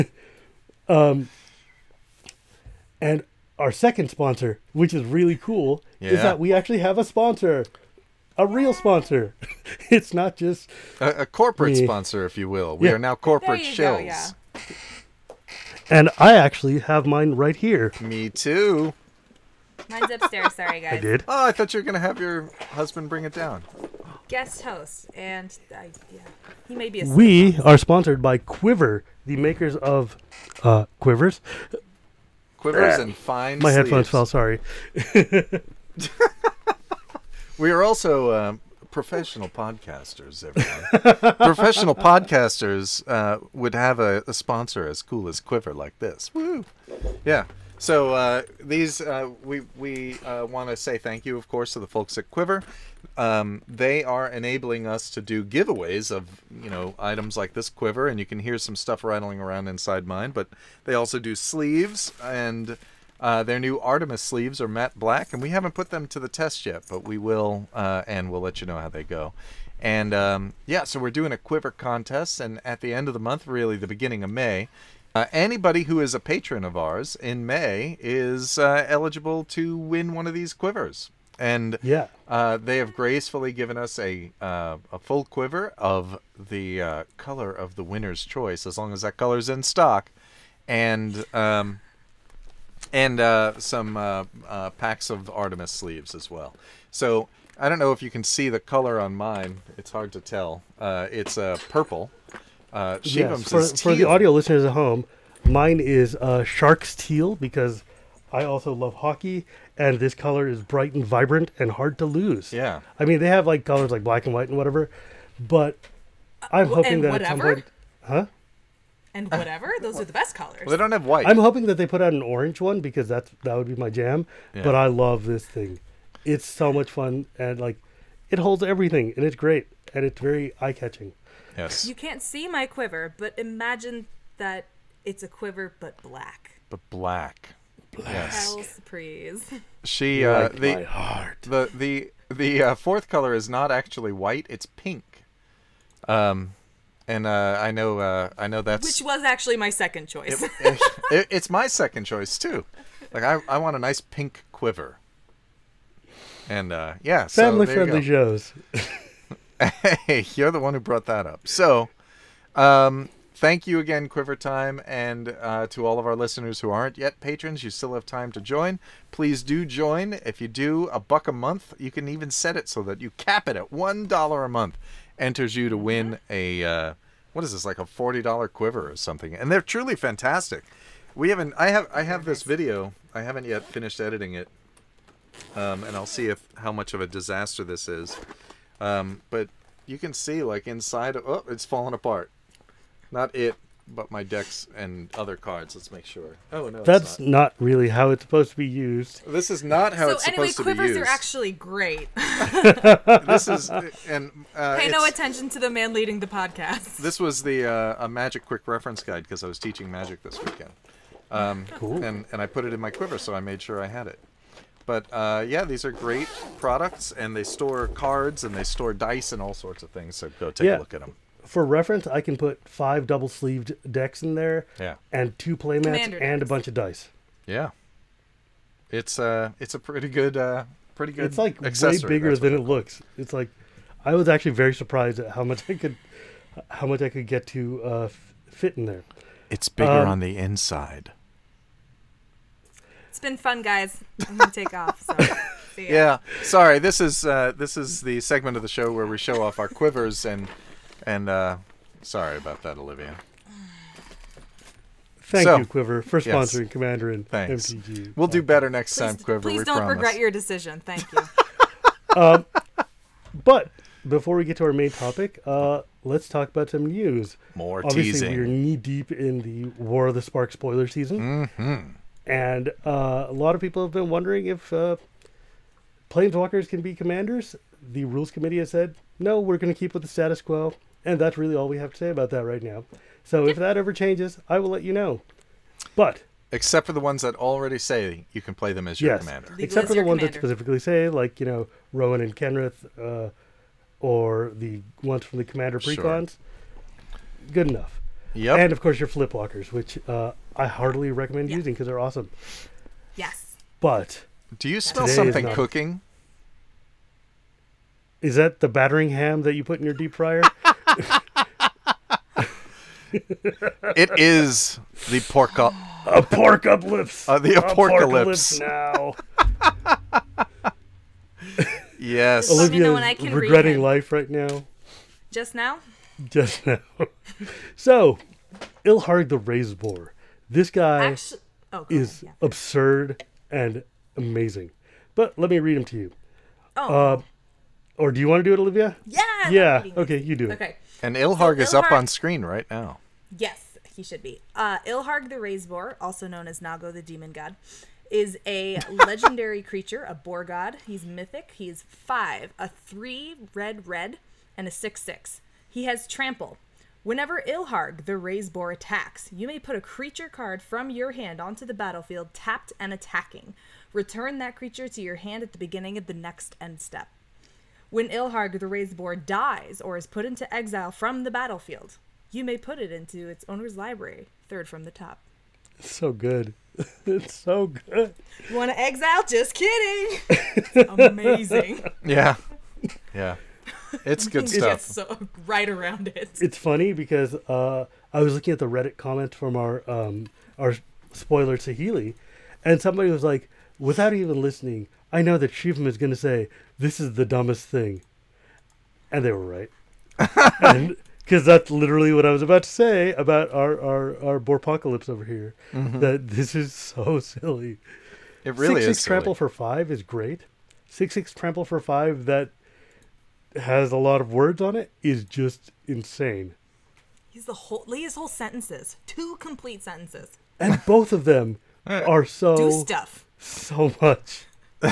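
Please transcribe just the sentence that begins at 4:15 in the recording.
Thank so, you, Quiver, for sponsoring yes.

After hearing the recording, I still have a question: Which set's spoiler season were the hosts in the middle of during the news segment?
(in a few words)
War of the Spark.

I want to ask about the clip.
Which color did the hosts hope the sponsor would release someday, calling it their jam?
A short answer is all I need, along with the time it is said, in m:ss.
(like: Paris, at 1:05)
Orange, at 2:02.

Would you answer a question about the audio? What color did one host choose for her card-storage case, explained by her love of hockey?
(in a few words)
Sharks teal.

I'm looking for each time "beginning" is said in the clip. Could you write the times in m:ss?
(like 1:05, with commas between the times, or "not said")
1:13, 6:05.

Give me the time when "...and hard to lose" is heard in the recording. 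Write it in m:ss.
1:51.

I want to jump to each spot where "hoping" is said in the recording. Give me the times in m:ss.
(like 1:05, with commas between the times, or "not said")
1:56, 2:01.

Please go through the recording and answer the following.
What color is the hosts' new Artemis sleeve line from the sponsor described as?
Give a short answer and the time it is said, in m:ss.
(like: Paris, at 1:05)
Matte black, at 1:04.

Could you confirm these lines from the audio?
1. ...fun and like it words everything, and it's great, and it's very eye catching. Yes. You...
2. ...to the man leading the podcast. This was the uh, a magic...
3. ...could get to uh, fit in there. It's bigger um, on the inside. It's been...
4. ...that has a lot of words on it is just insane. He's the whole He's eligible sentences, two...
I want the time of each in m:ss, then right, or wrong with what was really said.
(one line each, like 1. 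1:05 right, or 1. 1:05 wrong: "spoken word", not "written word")
1. 2:06 wrong: "holds", not "words"
2. 3:25 right
3. 3:57 right
4. 6:52 wrong: "whole", not "eligible".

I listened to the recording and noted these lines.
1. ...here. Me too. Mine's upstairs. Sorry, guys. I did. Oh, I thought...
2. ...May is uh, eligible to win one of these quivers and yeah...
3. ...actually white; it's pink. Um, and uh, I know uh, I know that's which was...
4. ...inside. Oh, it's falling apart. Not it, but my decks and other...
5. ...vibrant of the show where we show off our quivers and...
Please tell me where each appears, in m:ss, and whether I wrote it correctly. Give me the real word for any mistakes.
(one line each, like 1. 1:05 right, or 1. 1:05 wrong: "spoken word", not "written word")
1. 0:17 right
2. 1:17 right
3. 2:23 right
4. 3:10 right
5. 4:08 wrong: "segment", not "vibrant".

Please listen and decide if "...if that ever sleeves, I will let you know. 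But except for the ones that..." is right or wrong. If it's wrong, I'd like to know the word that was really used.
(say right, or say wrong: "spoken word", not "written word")
wrong: "changes", not "sleeves".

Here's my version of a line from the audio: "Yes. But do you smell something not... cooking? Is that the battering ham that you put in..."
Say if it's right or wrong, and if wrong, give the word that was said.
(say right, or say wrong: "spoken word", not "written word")
right.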